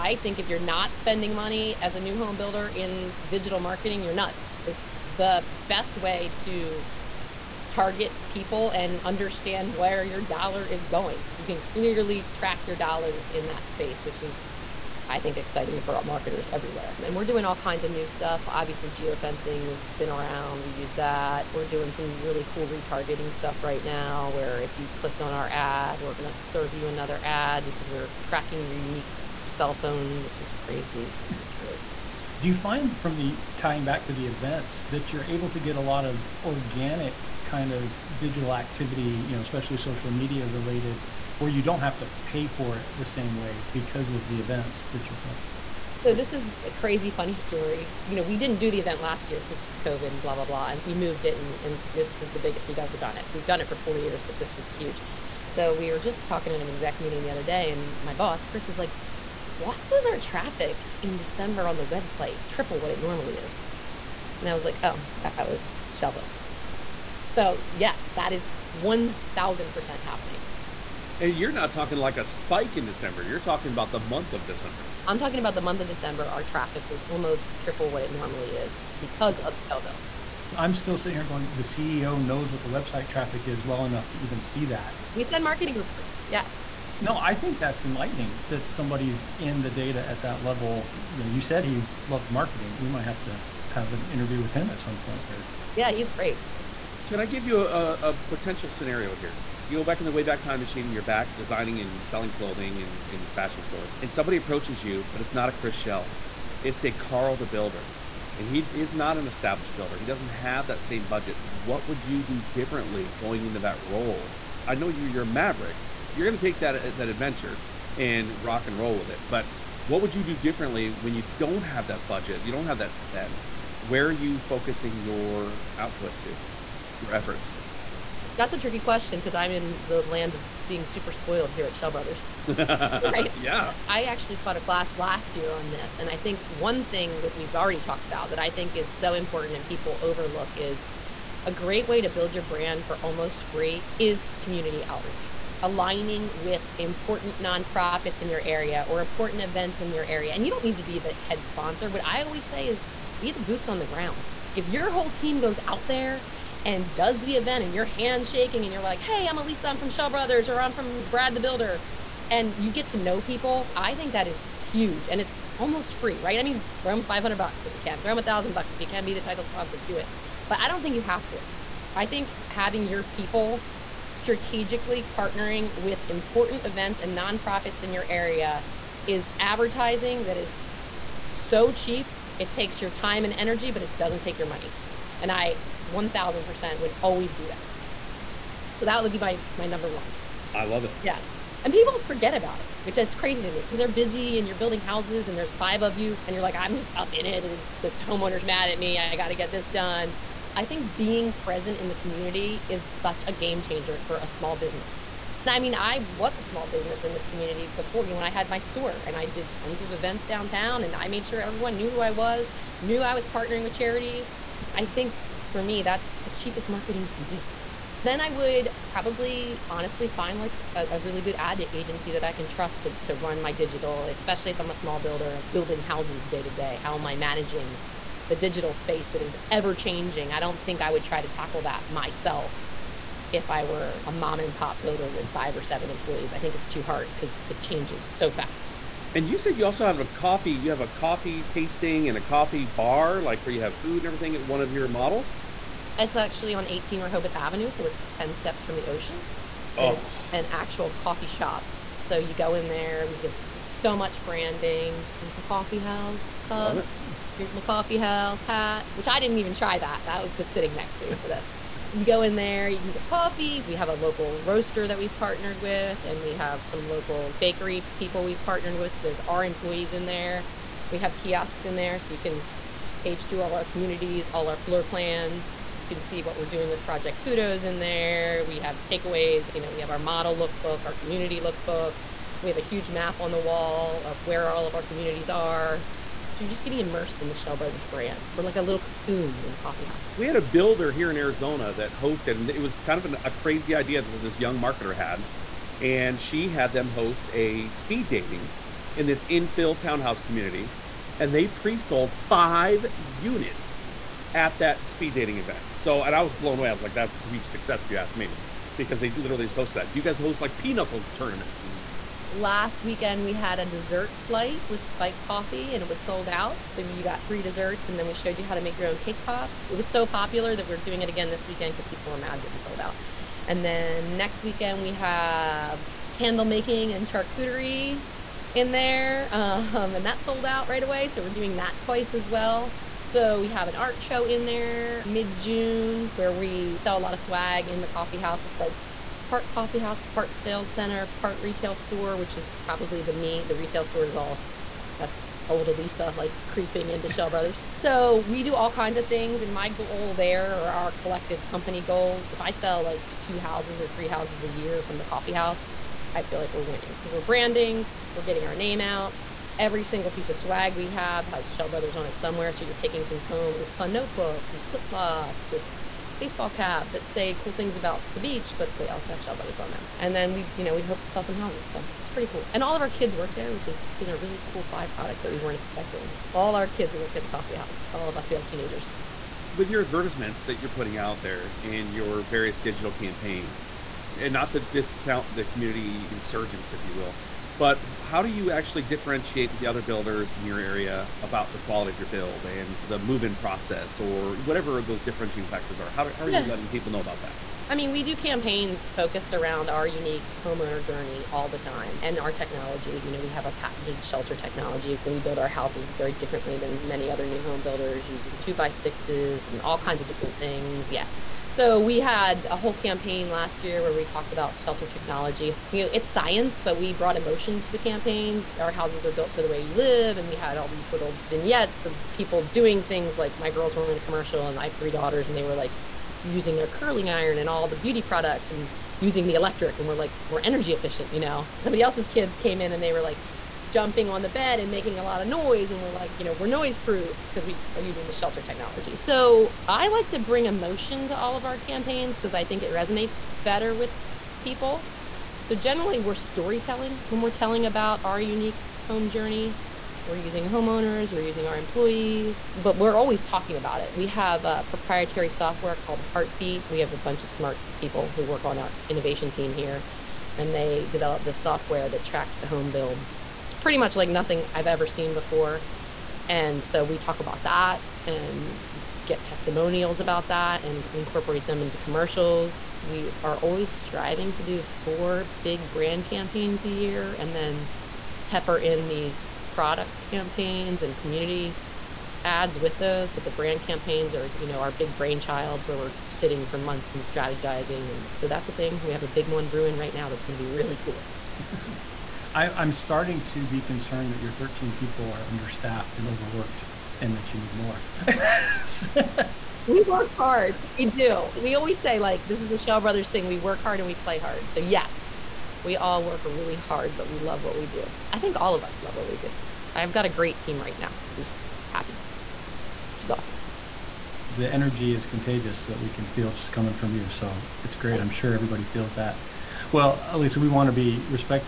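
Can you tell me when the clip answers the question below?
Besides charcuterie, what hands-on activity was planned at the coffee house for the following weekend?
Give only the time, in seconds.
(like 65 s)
326 s.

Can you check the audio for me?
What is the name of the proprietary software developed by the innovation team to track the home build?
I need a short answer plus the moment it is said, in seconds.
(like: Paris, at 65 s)
Heartbeat, at 456 s.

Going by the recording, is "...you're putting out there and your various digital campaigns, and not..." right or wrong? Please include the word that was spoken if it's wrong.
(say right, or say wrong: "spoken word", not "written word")
right.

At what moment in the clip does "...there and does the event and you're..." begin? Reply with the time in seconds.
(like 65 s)
155 s.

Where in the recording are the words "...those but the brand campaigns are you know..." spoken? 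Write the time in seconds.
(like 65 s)
482 s.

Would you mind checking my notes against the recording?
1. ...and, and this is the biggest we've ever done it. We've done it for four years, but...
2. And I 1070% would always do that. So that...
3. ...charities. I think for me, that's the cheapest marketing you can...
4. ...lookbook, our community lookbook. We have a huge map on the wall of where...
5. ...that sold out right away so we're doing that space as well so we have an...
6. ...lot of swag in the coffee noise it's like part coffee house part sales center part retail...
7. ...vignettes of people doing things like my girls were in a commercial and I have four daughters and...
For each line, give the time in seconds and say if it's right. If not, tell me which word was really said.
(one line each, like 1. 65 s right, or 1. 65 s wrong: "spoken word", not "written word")
1. 51 s right
2. 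185 s wrong: "1000", not "1070"
3. 213 s right
4. 280 s right
5. 330 s wrong: "twice", not "space"
6. 336 s wrong: "house", not "noise"
7. 421 s wrong: "three", not "four".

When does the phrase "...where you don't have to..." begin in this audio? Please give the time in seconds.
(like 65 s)
41 s.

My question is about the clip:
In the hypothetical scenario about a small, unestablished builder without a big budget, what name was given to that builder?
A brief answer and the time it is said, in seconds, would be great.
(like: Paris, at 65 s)
Carl the Builder, at 106 s.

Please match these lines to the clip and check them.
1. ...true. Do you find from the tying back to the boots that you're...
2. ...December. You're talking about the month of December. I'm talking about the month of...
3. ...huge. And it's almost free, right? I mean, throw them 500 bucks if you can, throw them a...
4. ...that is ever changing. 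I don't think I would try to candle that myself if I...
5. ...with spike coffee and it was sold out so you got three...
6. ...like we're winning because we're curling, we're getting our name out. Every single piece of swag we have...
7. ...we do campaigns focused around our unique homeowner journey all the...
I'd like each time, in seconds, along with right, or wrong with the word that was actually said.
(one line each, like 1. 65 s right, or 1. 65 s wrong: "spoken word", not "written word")
1. 31 s wrong: "events", not "boots"
2. 72 s right
3. 164 s right
4. 229 s wrong: "tackle", not "candle"
5. 314 s right
6. 356 s wrong: "branding", not "curling"
7. 397 s right.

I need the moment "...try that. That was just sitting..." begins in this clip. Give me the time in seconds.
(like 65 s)
259 s.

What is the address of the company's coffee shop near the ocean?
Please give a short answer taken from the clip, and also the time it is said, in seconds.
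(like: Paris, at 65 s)
18 Rehoboth Avenue, at 246 s.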